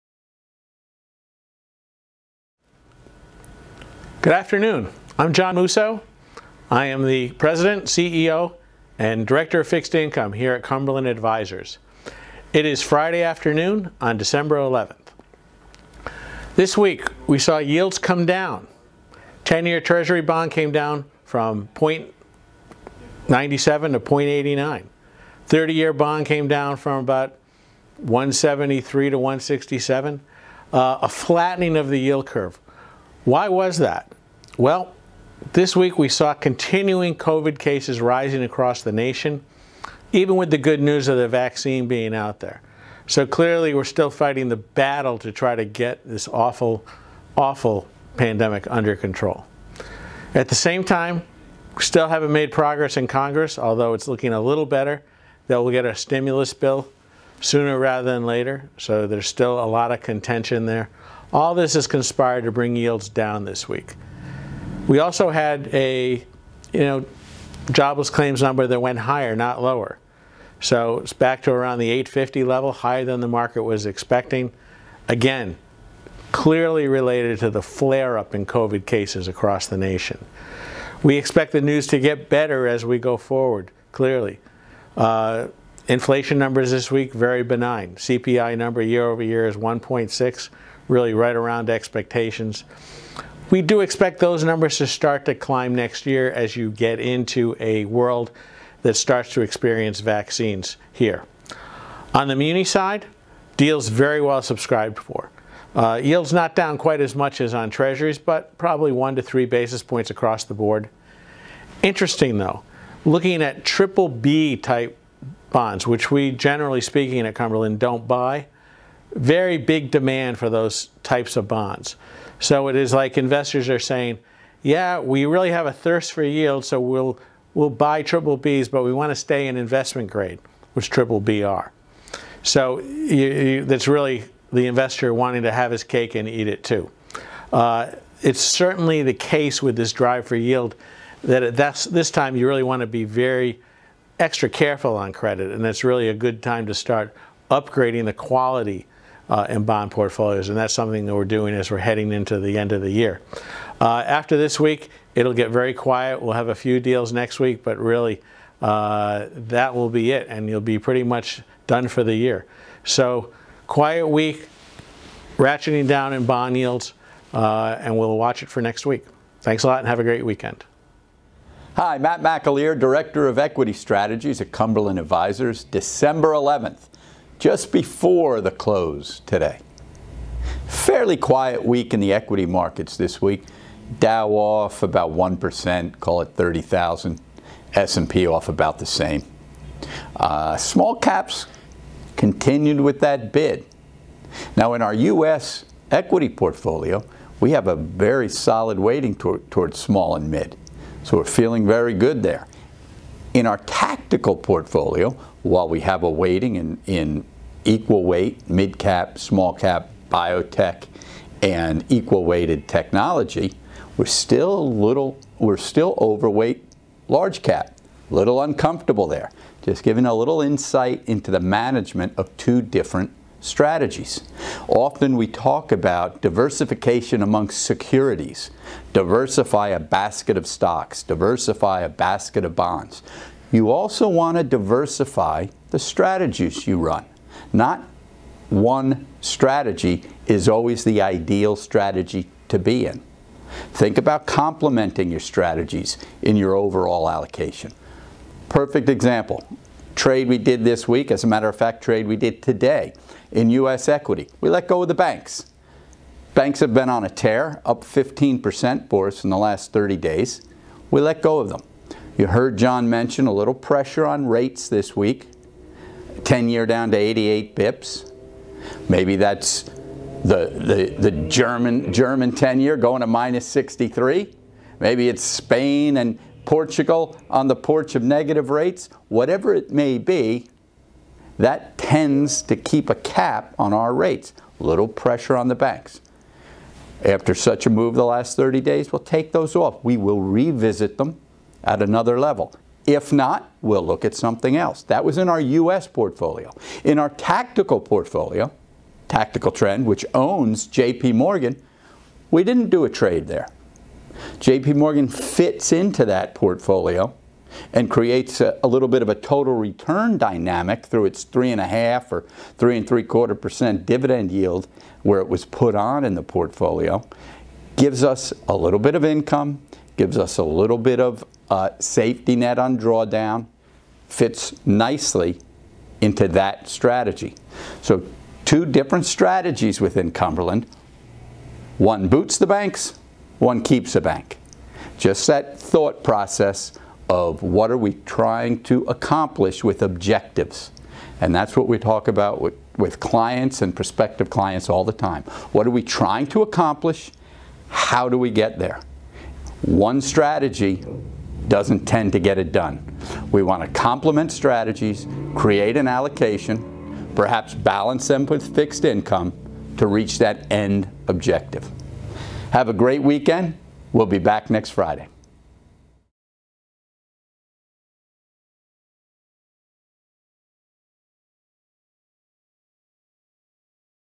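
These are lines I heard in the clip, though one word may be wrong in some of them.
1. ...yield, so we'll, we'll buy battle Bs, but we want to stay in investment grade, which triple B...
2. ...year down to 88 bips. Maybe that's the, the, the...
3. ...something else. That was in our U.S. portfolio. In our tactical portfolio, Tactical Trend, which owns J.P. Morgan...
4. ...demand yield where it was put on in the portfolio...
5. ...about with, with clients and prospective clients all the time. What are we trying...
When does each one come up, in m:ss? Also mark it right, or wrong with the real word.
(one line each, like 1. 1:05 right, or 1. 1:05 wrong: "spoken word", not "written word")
1. 2:06 wrong: "triple", not "battle"
2. 4:26 right
3. 4:54 right
4. 5:13 wrong: "dividend", not "demand"
5. 5:42 right.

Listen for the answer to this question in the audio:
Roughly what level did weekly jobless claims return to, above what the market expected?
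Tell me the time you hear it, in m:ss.
1:11.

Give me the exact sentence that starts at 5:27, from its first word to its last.
So two different strategies within Cumberland.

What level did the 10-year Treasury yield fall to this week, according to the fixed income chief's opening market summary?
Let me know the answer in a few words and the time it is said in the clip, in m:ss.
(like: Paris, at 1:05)
0.89, at 0:23.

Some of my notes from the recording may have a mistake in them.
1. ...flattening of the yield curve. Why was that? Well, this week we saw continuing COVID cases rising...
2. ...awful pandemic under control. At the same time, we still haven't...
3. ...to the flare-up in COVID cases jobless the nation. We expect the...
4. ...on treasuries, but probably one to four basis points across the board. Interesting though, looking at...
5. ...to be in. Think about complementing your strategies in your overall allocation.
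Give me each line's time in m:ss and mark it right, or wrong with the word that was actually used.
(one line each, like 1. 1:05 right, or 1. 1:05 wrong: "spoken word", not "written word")
1. 0:31 right
2. 0:47 right
3. 1:17 wrong: "across", not "jobless"
4. 1:47 wrong: "three", not "four"
5. 4:02 right.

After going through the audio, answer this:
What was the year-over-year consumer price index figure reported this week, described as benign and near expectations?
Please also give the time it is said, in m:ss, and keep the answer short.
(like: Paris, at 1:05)
1.6, at 1:29.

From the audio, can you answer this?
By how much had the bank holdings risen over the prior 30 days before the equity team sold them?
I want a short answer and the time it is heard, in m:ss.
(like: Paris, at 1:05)
15%, at 4:17.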